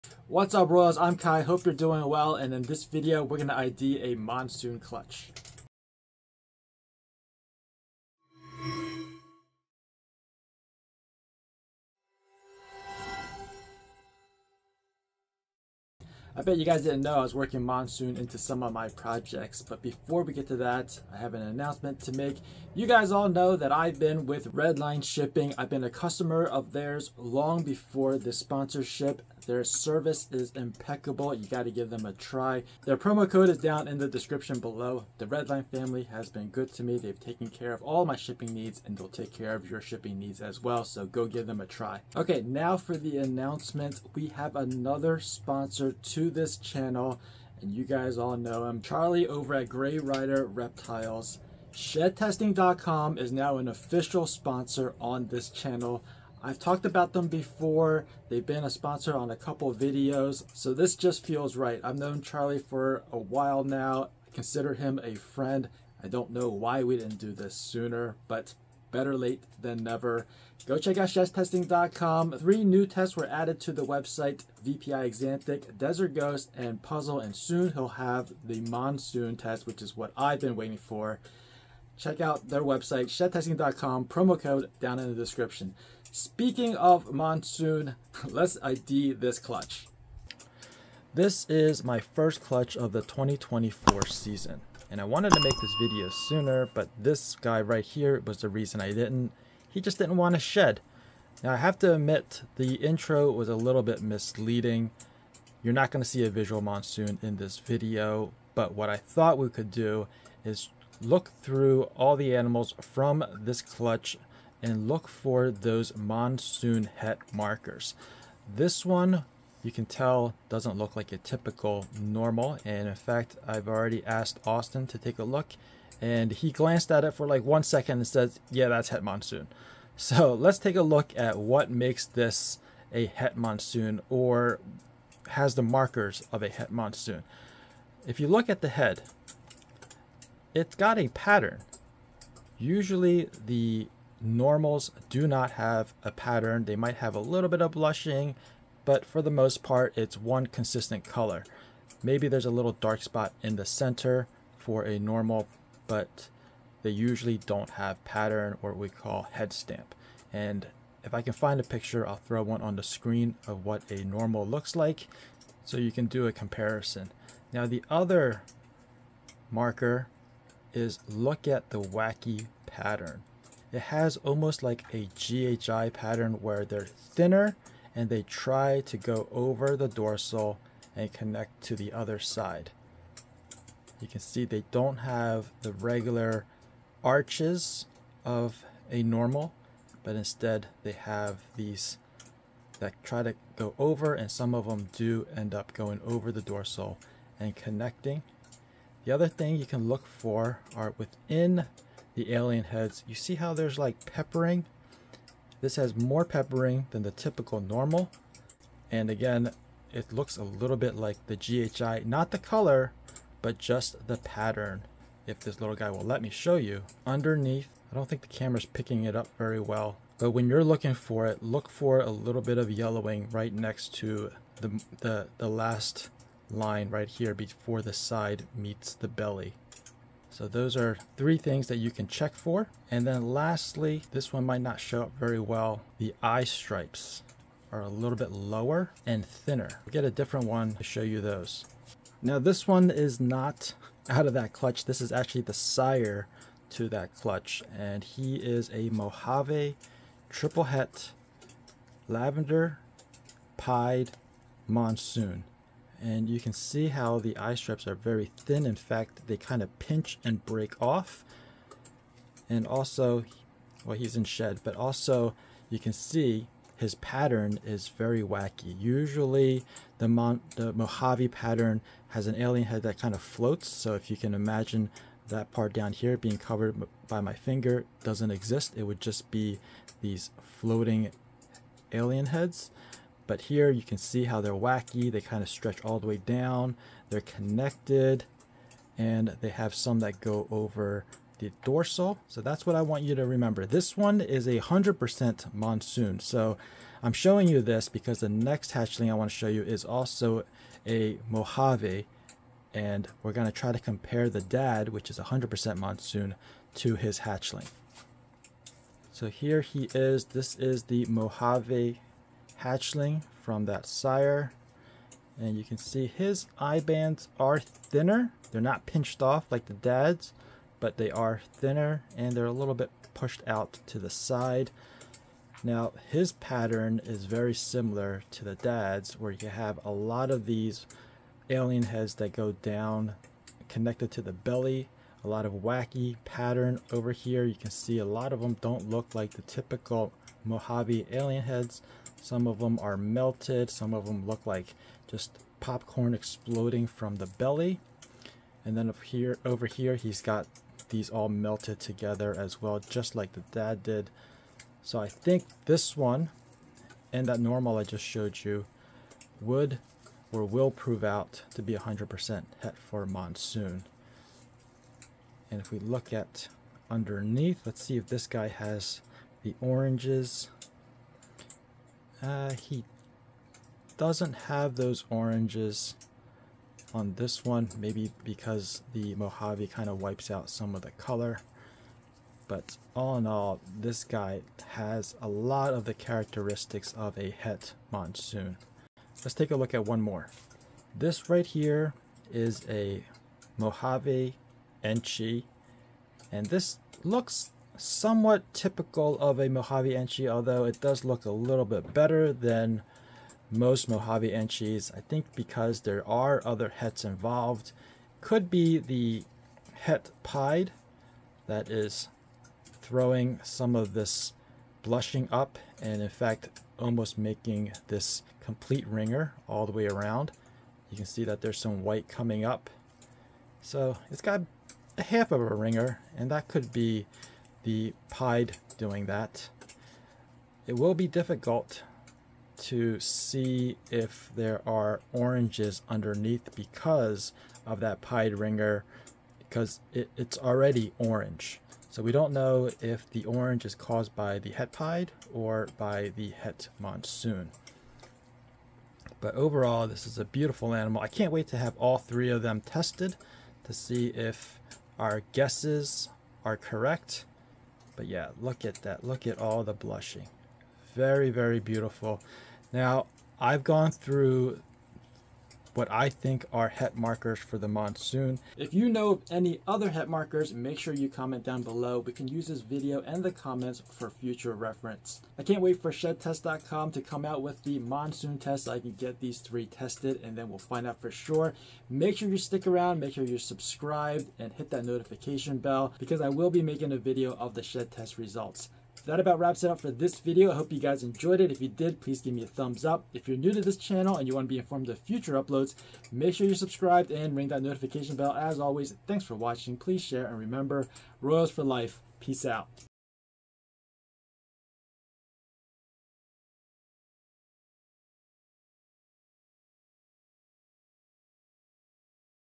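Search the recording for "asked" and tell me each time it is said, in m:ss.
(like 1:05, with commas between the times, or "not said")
2:04.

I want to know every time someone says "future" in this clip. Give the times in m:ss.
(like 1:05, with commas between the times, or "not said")
7:54, 8:14.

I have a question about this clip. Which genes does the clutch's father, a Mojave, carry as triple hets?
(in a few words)
Lavender Pied Monsoon.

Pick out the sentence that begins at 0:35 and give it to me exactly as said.
The Redline family has been good to me.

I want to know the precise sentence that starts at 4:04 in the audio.
This is actually the sire to that clutch.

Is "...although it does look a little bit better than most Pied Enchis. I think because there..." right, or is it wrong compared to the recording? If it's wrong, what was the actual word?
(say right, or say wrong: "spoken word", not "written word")
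wrong: "Mojave", not "Pied".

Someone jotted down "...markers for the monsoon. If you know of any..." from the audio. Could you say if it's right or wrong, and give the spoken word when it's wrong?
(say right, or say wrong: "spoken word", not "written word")
right.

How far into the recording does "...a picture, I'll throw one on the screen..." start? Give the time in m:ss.
2:41.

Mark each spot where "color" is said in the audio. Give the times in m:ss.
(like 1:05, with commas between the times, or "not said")
2:31, 3:32, 6:20.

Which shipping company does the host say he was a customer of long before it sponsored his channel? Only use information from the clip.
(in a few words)
Redline Shipping.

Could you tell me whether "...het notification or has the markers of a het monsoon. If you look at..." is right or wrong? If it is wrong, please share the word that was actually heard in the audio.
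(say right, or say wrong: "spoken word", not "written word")
wrong: "monsoon", not "notification".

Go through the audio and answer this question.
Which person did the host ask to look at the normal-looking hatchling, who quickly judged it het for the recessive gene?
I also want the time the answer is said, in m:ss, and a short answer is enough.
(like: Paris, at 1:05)
Austin, at 2:04.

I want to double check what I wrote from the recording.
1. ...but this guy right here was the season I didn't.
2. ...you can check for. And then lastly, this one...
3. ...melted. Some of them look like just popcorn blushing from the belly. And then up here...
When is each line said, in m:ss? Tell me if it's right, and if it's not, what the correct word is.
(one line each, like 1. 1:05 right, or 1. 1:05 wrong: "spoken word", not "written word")
1. 1:36 wrong: "reason", not "season"
2. 3:51 right
3. 5:42 wrong: "exploding", not "blushing".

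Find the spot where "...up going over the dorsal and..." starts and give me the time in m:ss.
3:15.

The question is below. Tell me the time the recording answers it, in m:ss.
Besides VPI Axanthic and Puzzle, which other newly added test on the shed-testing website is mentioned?
1:15.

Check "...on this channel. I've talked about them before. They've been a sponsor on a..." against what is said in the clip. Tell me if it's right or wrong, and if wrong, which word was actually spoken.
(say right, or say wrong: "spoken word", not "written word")
right.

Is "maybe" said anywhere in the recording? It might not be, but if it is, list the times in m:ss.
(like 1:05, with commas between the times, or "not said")
2:32, 6:17.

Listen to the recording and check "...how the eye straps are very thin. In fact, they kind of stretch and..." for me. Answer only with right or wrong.
wrong.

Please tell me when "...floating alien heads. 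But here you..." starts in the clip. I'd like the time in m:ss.
4:40.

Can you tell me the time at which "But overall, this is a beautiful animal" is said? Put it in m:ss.
7:29.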